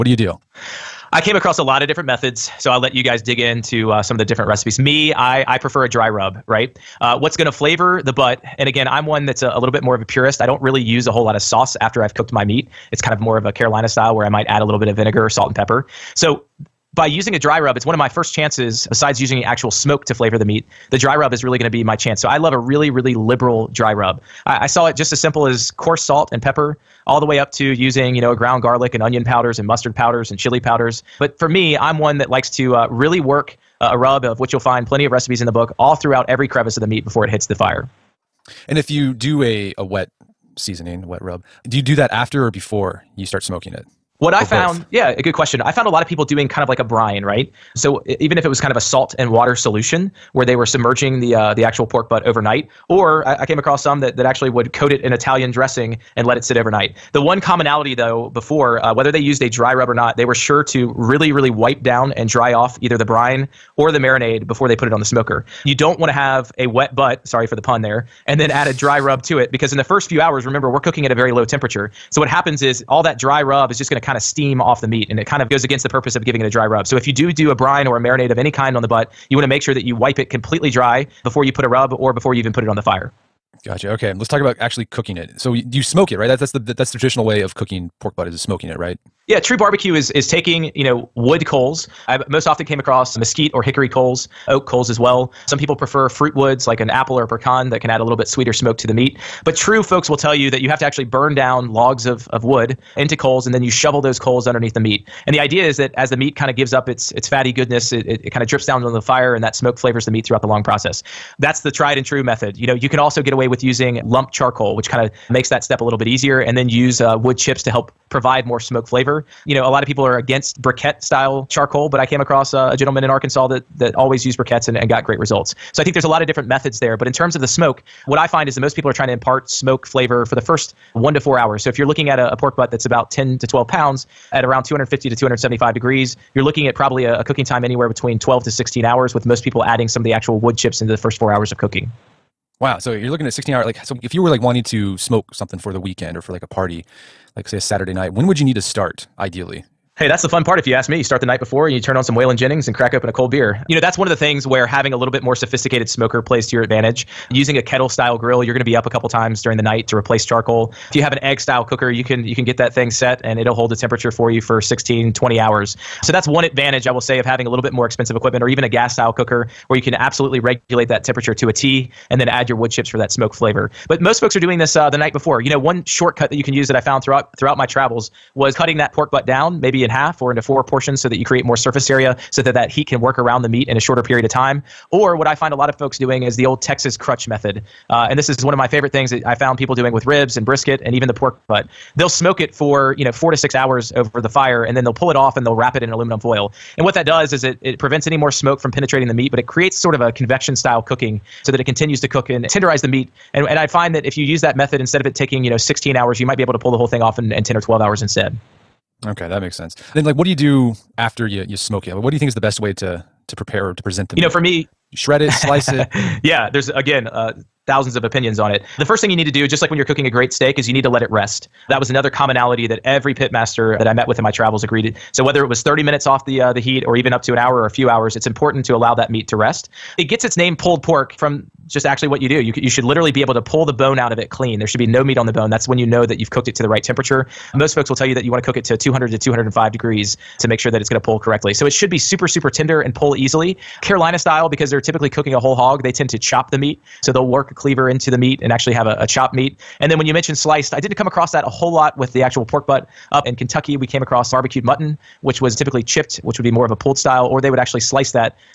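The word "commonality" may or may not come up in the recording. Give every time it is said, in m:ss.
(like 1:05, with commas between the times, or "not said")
0:57, 3:42.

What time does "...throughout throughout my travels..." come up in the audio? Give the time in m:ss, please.
2:57.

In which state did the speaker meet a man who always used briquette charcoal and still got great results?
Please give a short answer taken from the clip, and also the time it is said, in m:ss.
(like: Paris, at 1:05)
Arkansas, at 2:03.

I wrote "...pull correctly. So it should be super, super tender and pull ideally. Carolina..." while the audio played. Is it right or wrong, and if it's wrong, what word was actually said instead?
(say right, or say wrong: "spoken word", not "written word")
wrong: "easily", not "ideally".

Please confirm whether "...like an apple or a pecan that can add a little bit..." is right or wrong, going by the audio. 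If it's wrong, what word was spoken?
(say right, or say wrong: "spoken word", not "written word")
right.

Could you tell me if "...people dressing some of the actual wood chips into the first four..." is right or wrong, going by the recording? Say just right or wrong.
wrong.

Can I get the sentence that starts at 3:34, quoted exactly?
know, for me, shred it, slice it.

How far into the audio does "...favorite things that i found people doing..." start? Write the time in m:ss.
3:08.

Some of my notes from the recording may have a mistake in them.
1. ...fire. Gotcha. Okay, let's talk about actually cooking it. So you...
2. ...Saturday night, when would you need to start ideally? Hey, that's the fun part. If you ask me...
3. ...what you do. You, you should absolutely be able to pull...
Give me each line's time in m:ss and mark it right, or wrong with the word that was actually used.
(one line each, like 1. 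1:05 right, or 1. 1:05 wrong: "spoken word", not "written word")
1. 1:22 right
2. 2:27 right
3. 3:52 wrong: "literally", not "absolutely".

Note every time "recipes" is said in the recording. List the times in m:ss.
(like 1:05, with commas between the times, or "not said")
0:04, 0:35.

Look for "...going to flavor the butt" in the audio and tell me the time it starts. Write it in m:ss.
0:07.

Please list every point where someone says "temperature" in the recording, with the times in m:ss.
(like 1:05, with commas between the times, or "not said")
1:11, 2:43, 2:51, 3:56.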